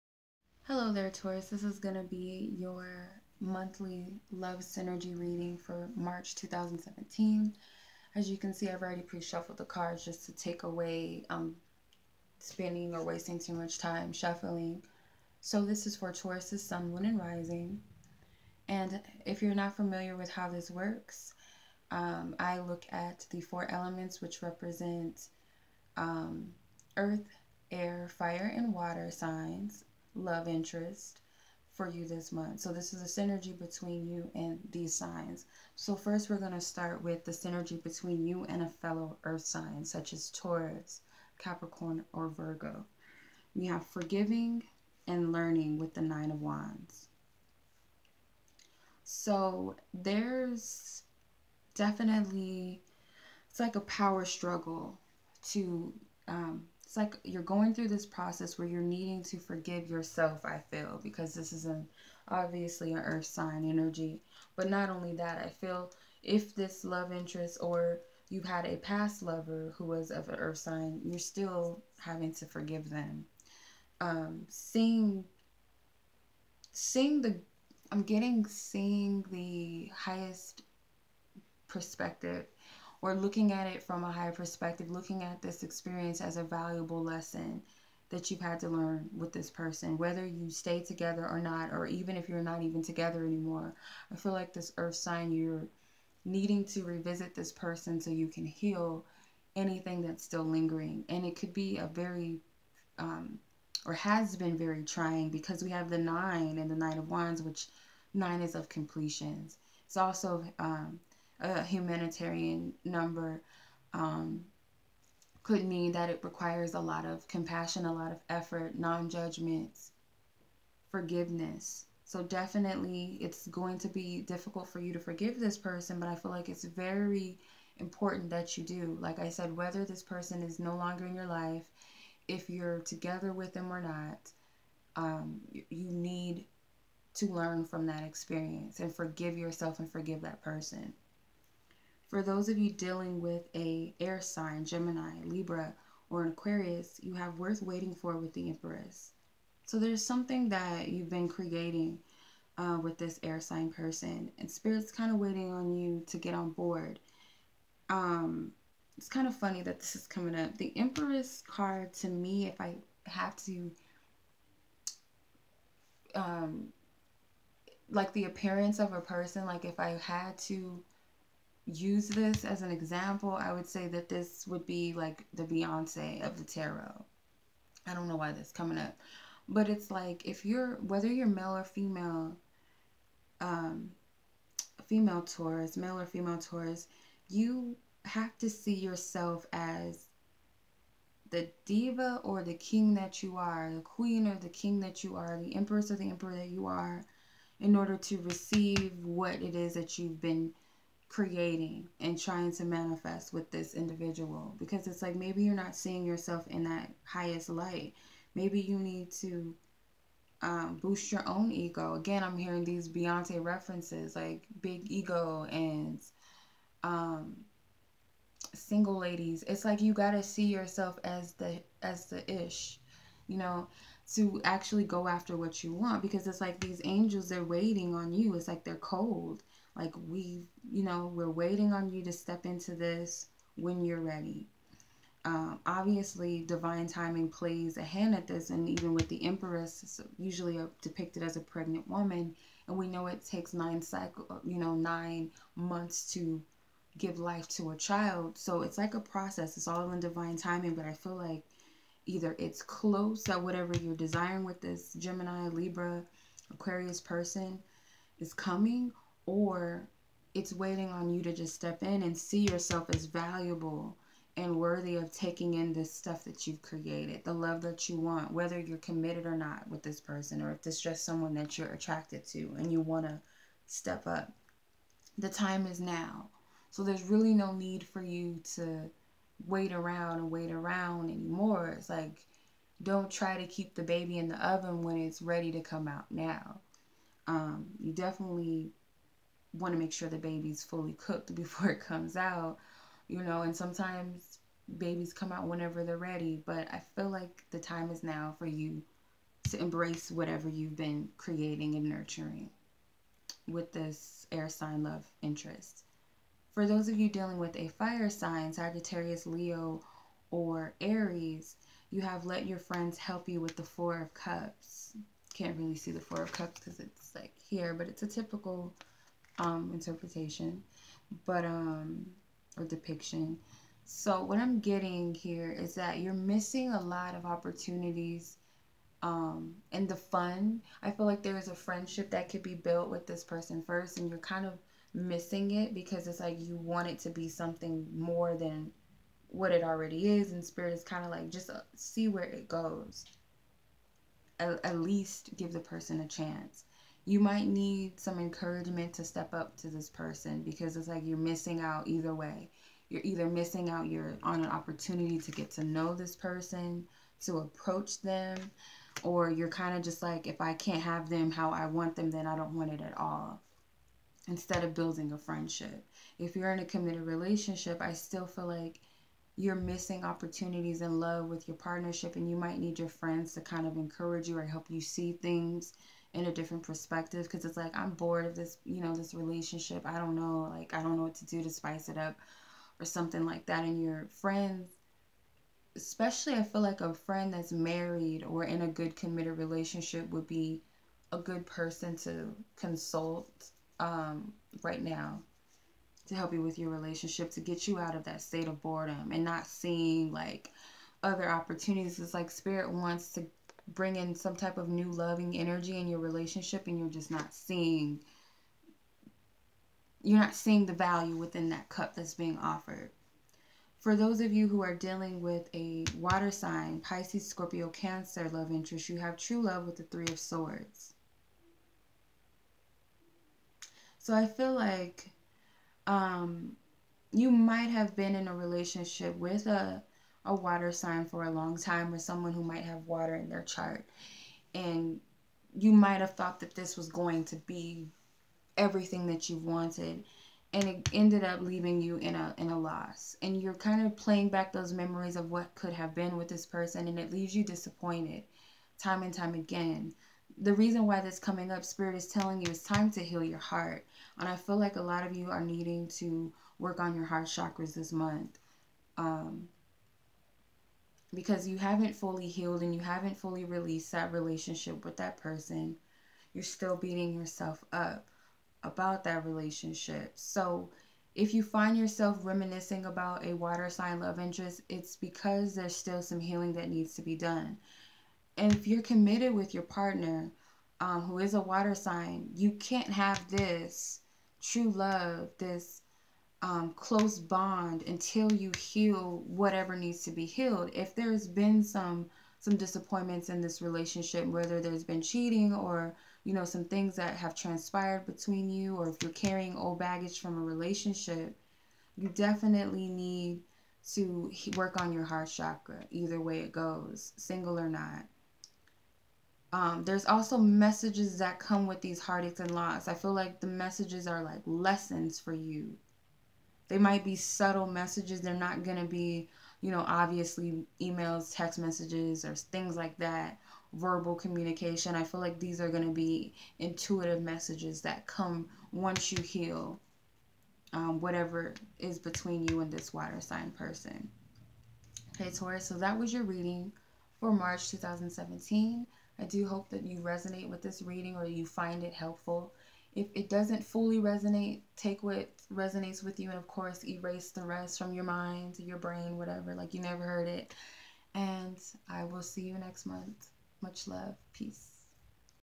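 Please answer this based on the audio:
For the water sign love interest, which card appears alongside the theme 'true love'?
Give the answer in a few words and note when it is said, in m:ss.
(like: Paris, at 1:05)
3 of Swords, at 6:59.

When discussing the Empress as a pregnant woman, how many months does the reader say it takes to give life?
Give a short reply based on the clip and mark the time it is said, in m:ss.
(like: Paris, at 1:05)
9, at 4:04.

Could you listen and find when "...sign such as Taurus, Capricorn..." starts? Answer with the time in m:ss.
0:39.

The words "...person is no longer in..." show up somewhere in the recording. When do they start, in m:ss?
2:10.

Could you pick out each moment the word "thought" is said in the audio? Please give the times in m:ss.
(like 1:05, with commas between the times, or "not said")
7:16.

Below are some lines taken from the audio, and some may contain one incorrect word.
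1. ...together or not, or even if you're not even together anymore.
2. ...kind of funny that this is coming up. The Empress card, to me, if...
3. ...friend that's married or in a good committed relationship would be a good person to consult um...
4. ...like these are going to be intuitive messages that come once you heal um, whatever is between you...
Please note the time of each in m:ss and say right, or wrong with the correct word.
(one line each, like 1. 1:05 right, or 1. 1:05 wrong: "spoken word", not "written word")
1. 1:30 right
2. 2:39 right
3. 6:26 right
4. 8:45 right.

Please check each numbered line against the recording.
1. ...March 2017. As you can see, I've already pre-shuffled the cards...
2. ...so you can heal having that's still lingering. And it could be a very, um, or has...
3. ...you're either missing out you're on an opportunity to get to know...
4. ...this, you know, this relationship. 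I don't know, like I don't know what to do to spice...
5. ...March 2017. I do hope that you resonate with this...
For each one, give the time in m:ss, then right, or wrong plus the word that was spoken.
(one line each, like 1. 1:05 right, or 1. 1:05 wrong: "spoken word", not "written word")
1. 0:05 right
2. 1:37 wrong: "anything", not "having"
3. 5:52 right
4. 6:18 right
5. 8:57 right.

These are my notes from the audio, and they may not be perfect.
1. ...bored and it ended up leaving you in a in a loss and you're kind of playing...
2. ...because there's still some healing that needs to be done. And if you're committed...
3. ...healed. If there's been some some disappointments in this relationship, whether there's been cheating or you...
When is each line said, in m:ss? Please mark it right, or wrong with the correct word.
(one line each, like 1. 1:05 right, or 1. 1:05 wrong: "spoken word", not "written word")
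1. 7:19 wrong: "wanted", not "bored"
2. 7:54 right
3. 8:10 right.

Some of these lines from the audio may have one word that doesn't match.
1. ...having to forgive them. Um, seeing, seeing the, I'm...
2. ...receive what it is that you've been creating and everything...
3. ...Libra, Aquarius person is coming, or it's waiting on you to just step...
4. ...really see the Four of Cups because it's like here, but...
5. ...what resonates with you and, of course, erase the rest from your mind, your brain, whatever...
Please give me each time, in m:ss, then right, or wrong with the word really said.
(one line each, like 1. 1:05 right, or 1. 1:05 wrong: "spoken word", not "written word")
1. 1:11 right
2. 3:18 wrong: "trying", not "everything"
3. 4:15 right
4. 5:15 right
5. 9:05 right.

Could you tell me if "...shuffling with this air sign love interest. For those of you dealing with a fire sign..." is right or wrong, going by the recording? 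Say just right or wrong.
wrong.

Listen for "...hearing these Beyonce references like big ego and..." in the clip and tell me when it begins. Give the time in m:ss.
3:32.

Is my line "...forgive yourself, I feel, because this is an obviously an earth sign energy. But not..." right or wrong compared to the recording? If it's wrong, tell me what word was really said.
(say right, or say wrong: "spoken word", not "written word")
right.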